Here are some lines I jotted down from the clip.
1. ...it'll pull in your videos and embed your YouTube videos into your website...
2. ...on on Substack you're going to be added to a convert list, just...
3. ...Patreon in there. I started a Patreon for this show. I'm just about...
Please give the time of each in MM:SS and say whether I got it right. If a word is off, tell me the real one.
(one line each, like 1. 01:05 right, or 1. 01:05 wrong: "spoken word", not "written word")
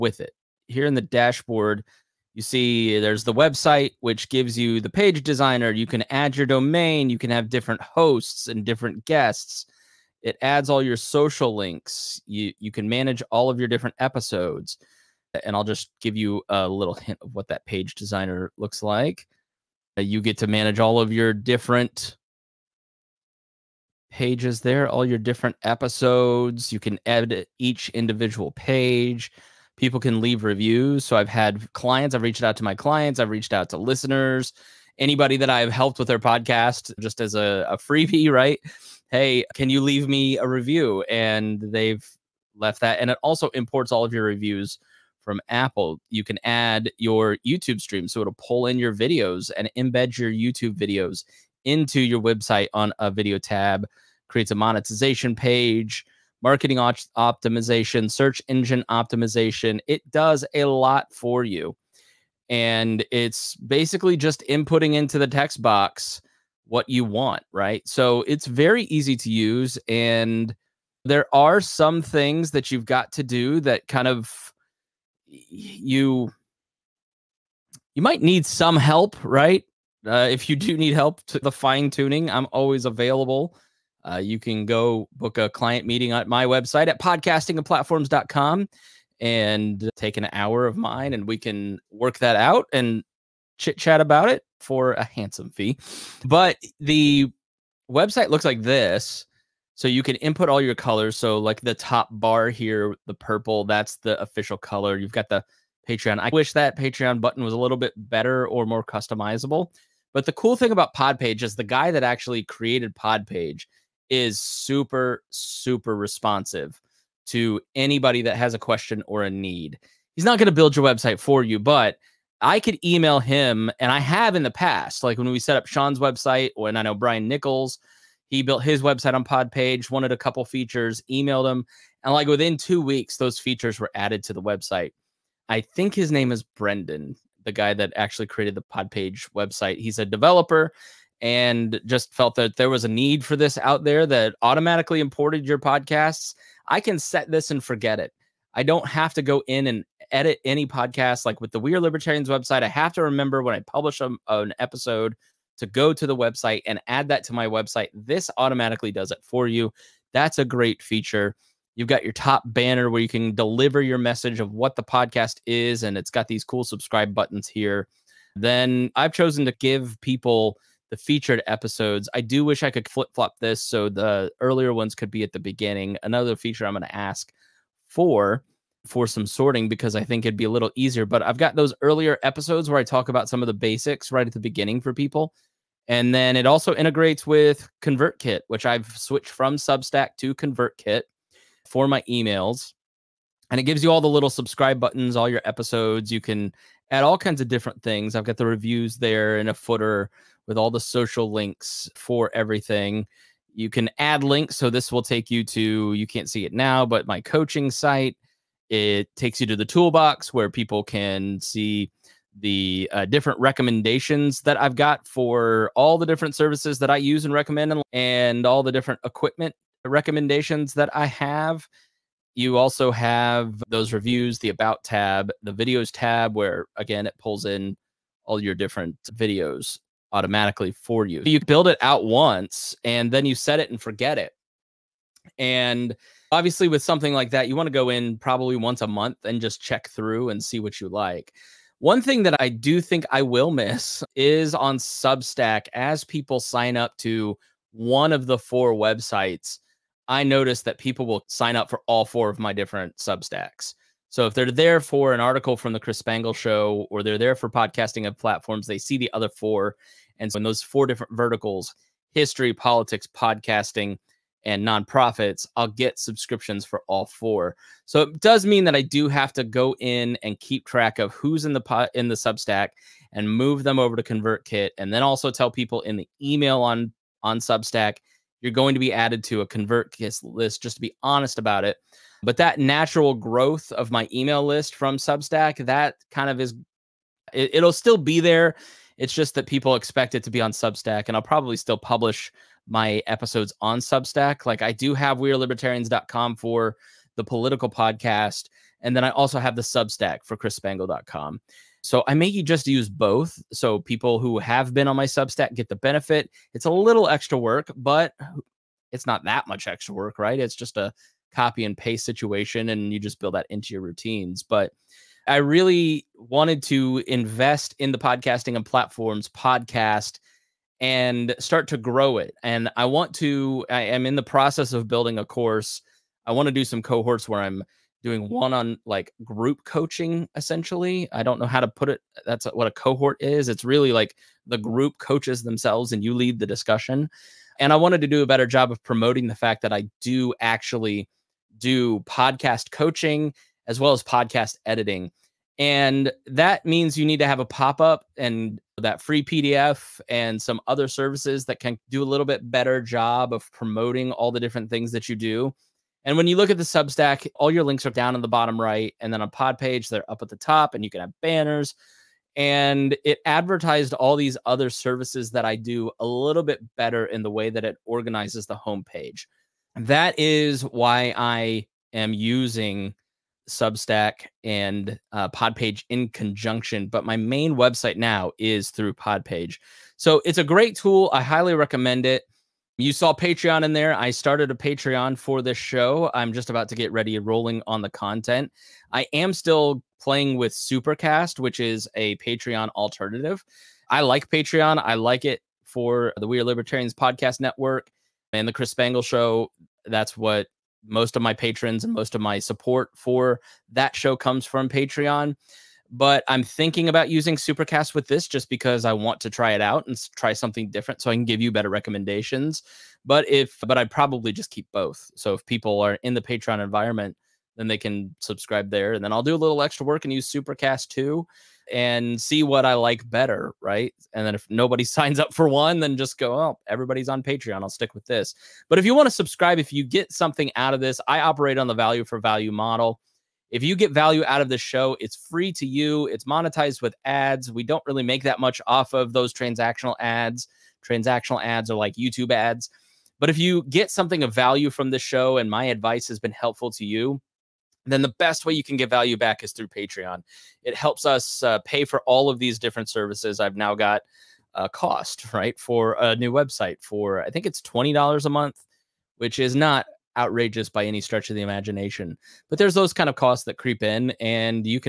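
1. 00:48 right
2. 04:36 right
3. 06:23 right.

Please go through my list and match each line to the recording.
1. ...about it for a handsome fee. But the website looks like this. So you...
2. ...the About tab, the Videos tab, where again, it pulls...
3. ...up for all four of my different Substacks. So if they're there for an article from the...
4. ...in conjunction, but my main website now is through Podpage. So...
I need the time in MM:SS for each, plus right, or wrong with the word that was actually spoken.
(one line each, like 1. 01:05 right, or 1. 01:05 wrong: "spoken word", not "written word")
1. 01:34 right
2. 03:44 right
3. 04:11 right
4. 06:15 right.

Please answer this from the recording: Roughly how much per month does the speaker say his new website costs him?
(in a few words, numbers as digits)
$20.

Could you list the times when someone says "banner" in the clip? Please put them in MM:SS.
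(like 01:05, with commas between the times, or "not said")
02:42, 06:01.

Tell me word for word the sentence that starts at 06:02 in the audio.
And it advertised all these other services that I do a little bit better in the way that it organizes the homepage.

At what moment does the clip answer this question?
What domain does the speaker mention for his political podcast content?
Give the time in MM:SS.
04:55.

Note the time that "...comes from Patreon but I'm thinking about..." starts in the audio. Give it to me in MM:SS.
06:44.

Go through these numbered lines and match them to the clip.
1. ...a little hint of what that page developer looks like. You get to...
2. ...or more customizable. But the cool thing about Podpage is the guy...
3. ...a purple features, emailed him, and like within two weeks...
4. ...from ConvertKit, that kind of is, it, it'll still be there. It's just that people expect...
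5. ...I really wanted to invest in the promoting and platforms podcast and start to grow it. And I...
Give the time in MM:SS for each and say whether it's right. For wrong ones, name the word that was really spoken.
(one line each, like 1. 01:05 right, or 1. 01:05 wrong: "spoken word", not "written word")
1. 00:16 wrong: "designer", not "developer"
2. 01:48 right
3. 02:10 wrong: "couple", not "purple"
4. 04:44 wrong: "Substack", not "ConvertKit"
5. 05:15 wrong: "podcasting", not "promoting".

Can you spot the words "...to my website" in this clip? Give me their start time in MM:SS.
02:37.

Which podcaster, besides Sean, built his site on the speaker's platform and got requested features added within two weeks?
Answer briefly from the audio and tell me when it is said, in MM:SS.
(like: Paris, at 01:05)
Brian Nichols, at 02:06.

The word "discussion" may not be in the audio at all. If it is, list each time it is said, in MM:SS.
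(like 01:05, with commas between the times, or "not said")
05:36.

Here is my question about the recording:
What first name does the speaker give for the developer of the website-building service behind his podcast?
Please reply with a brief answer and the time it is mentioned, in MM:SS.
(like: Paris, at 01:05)
Brendan, at 02:16.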